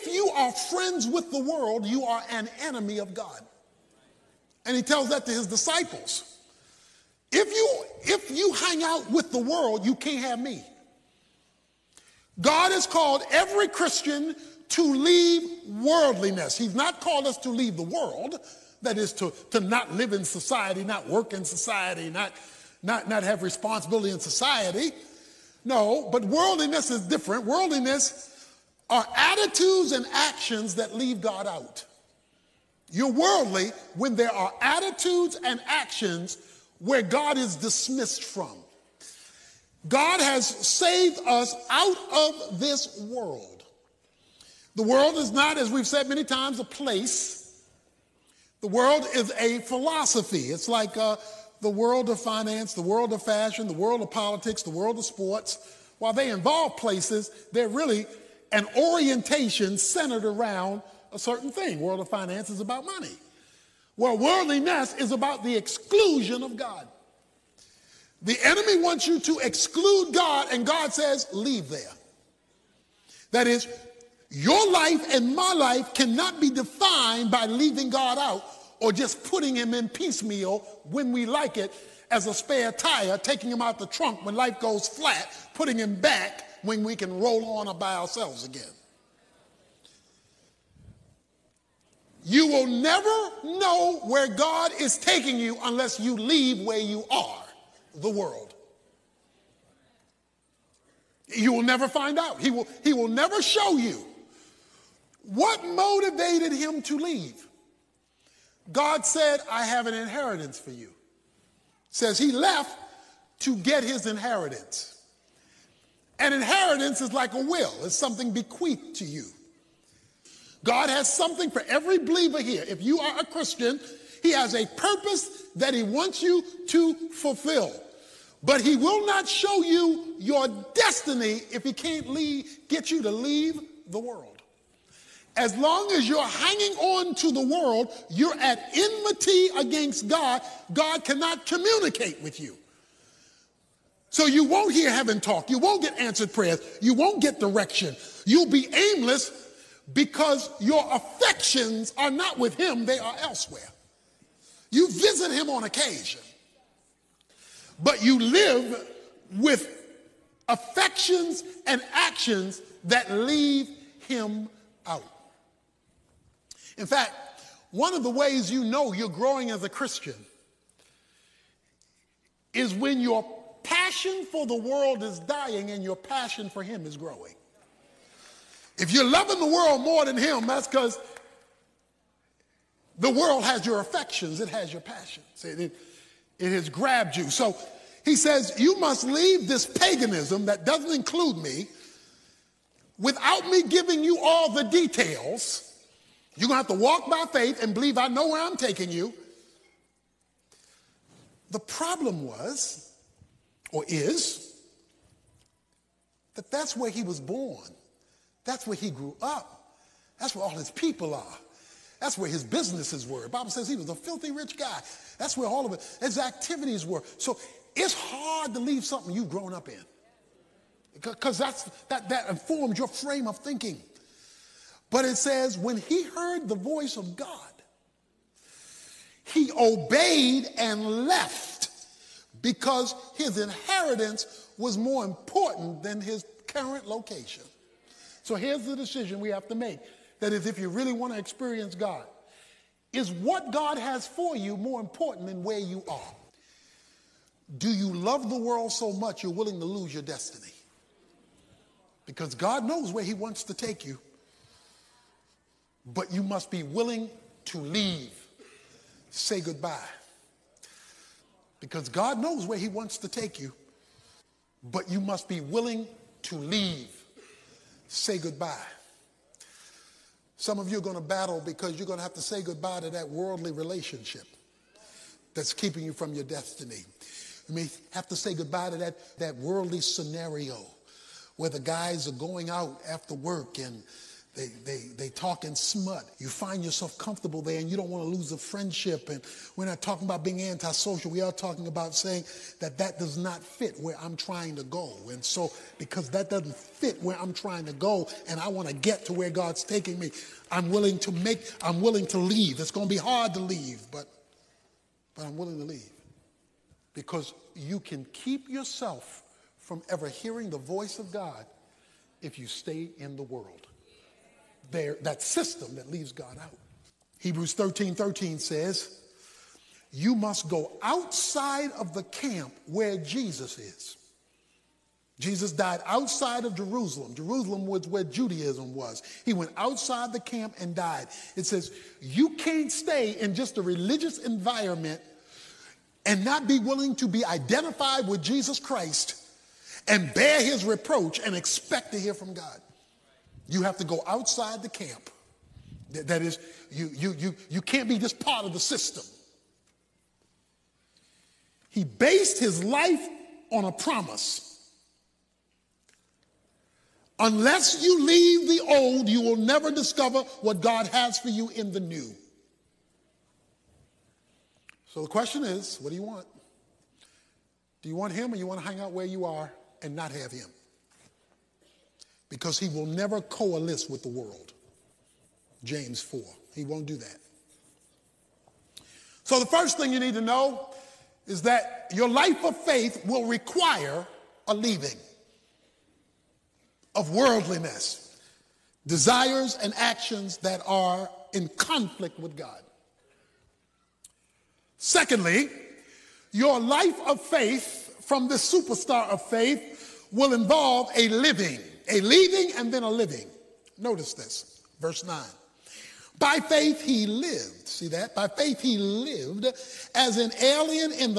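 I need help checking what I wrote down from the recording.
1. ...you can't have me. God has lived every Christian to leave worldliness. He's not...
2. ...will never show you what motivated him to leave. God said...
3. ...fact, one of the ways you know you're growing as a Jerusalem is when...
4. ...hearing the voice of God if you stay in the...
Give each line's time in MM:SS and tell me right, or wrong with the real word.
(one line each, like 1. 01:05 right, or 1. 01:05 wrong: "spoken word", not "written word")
1. 00:09 wrong: "called", not "lived"
2. 01:42 right
3. 02:46 wrong: "Christian", not "Jerusalem"
4. 05:10 right.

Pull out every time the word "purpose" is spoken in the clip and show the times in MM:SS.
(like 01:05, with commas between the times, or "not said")
02:04.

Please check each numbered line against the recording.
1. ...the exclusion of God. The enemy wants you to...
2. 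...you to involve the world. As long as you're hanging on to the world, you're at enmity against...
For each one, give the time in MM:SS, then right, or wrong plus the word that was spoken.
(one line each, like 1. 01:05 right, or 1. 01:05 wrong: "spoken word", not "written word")
1. 01:05 right
2. 02:12 wrong: "leave", not "involve".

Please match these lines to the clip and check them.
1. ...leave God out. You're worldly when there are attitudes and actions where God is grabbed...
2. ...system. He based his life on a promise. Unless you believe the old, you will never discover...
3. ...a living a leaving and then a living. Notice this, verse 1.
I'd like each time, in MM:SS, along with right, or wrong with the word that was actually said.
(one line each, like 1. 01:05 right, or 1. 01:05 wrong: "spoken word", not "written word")
1. 00:30 wrong: "dismissed", not "grabbed"
2. 05:48 wrong: "leave", not "believe"
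3. 06:40 wrong: "9", not "1".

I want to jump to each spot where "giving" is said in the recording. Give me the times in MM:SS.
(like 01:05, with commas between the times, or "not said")
03:13.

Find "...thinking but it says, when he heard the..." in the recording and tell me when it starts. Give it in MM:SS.
03:43.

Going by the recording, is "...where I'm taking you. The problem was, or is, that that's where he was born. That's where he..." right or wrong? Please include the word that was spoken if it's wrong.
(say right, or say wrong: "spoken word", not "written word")
right.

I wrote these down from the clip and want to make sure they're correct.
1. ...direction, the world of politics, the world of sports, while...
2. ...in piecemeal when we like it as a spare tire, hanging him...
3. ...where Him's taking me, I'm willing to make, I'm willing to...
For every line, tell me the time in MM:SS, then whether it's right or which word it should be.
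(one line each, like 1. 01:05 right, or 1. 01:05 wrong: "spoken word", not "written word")
1. 00:53 wrong: "fashion", not "direction"
2. 01:19 wrong: "taking", not "hanging"
3. 04:59 wrong: "God", not "Him".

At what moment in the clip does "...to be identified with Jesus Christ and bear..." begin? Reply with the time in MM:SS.
05:36.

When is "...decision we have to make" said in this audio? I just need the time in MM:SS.
03:58.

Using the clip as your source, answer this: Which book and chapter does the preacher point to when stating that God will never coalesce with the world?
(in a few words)
James 4.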